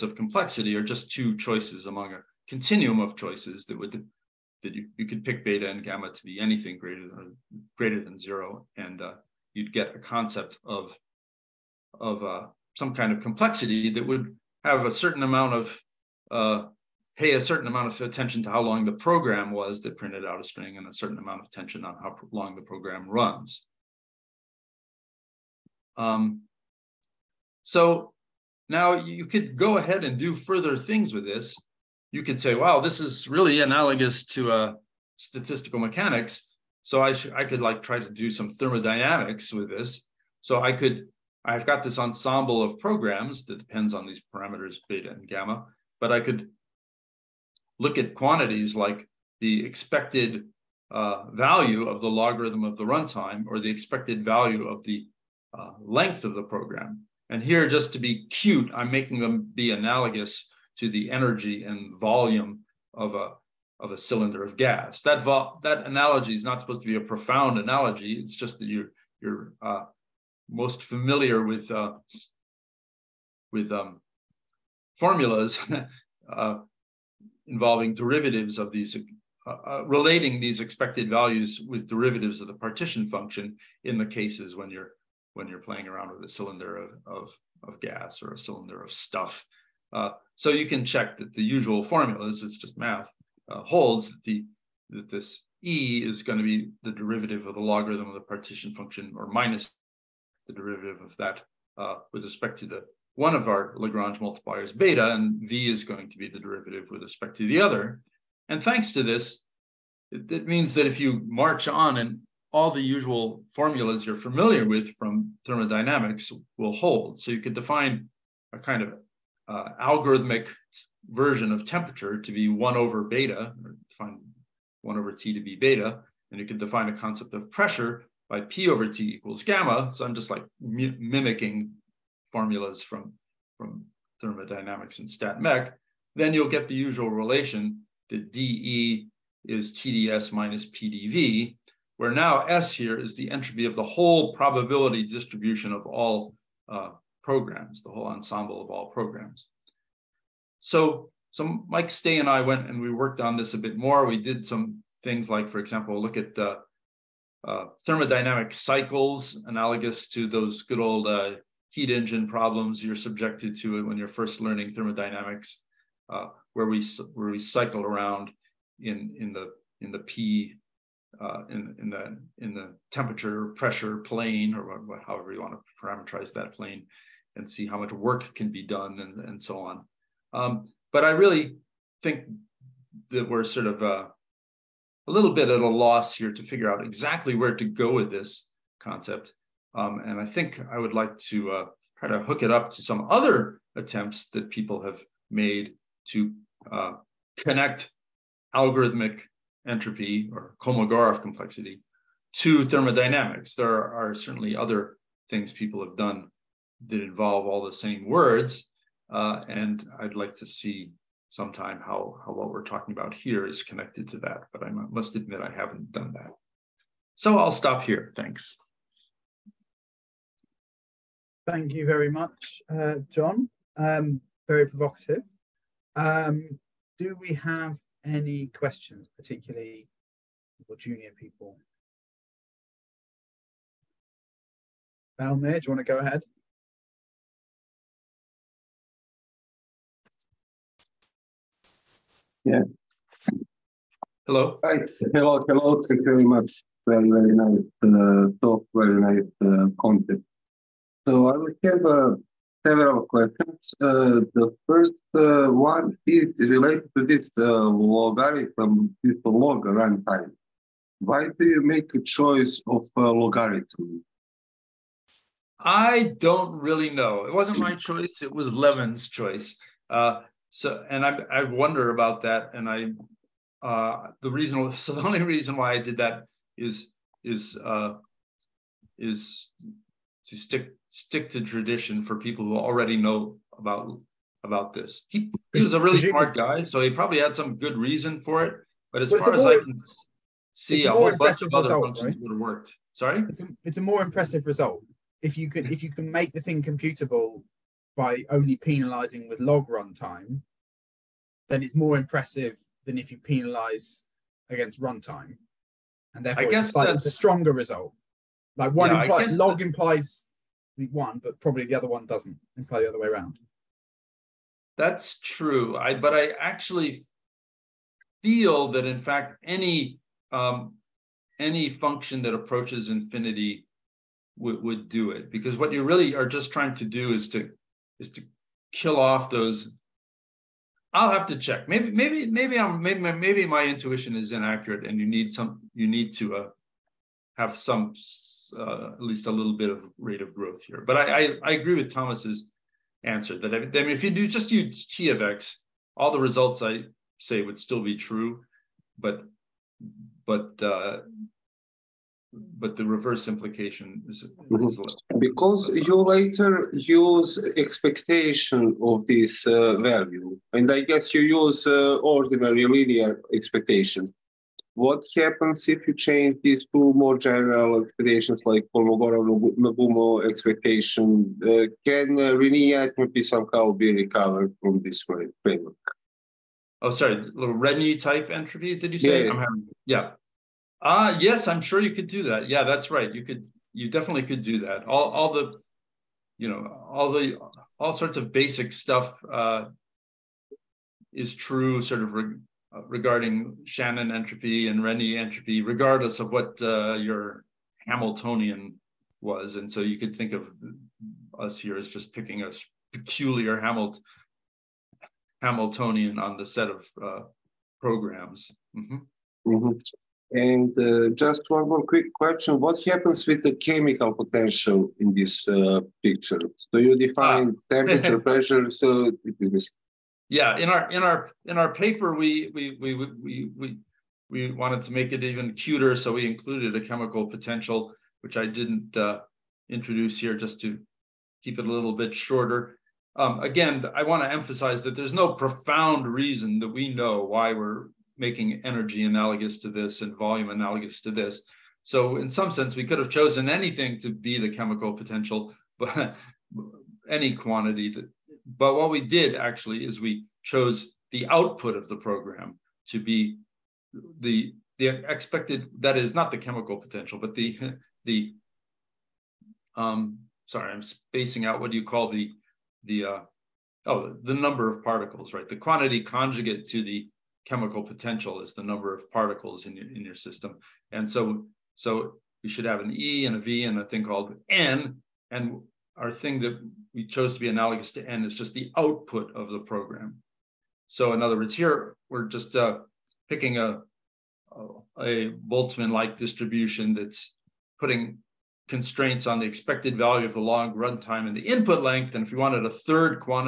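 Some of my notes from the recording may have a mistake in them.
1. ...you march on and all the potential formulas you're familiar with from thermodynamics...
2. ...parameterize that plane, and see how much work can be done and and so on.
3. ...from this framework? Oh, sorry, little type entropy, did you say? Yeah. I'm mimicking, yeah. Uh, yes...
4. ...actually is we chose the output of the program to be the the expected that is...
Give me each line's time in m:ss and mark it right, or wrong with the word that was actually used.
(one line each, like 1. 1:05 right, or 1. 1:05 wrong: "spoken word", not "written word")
1. 1:50 wrong: "usual", not "potential"
2. 2:55 right
3. 6:14 wrong: "having", not "mimicking"
4. 7:29 right.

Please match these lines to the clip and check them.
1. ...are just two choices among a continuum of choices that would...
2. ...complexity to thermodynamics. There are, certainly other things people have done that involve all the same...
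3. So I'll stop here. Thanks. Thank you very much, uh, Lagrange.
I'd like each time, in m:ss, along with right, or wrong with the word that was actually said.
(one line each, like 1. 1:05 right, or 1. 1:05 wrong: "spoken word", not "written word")
1. 0:00 right
2. 3:21 right
3. 3:37 wrong: "John", not "Lagrange".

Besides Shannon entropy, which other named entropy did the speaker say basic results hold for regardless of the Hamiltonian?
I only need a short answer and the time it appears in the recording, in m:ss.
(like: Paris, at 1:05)
Renyi entropy, at 6:34.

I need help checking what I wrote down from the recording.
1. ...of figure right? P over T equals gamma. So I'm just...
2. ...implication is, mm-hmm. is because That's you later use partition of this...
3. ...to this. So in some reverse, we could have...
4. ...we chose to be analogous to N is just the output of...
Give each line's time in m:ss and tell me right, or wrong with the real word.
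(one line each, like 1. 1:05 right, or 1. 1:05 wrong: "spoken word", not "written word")
1. 2:07 wrong: "pressure", not "figure"
2. 5:53 wrong: "expectation", not "partition"
3. 7:21 wrong: "sense", not "reverse"
4. 7:56 right.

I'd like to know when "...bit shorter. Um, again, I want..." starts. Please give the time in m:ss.
7:11.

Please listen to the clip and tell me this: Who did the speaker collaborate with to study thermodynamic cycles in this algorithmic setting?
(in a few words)
Mike Stay.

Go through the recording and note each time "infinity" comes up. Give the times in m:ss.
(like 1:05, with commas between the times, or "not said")
5:22.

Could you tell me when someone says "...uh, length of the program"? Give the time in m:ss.
0:55.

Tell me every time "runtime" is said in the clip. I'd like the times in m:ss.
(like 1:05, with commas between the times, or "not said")
0:52, 4:19, 4:59, 5:04, 8:10.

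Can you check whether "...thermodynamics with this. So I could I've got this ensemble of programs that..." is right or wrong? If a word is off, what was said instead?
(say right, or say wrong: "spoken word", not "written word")
right.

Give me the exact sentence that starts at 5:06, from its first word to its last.
And therefore, I guess it's, like, a stronger result.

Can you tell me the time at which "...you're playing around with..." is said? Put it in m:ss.
1:25.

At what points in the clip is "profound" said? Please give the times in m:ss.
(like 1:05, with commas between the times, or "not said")
1:07, 7:15.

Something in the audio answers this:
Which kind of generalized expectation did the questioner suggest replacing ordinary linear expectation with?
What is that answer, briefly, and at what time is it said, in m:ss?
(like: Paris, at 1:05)
Kolmogorov-Nagumo expectation, at 6:08.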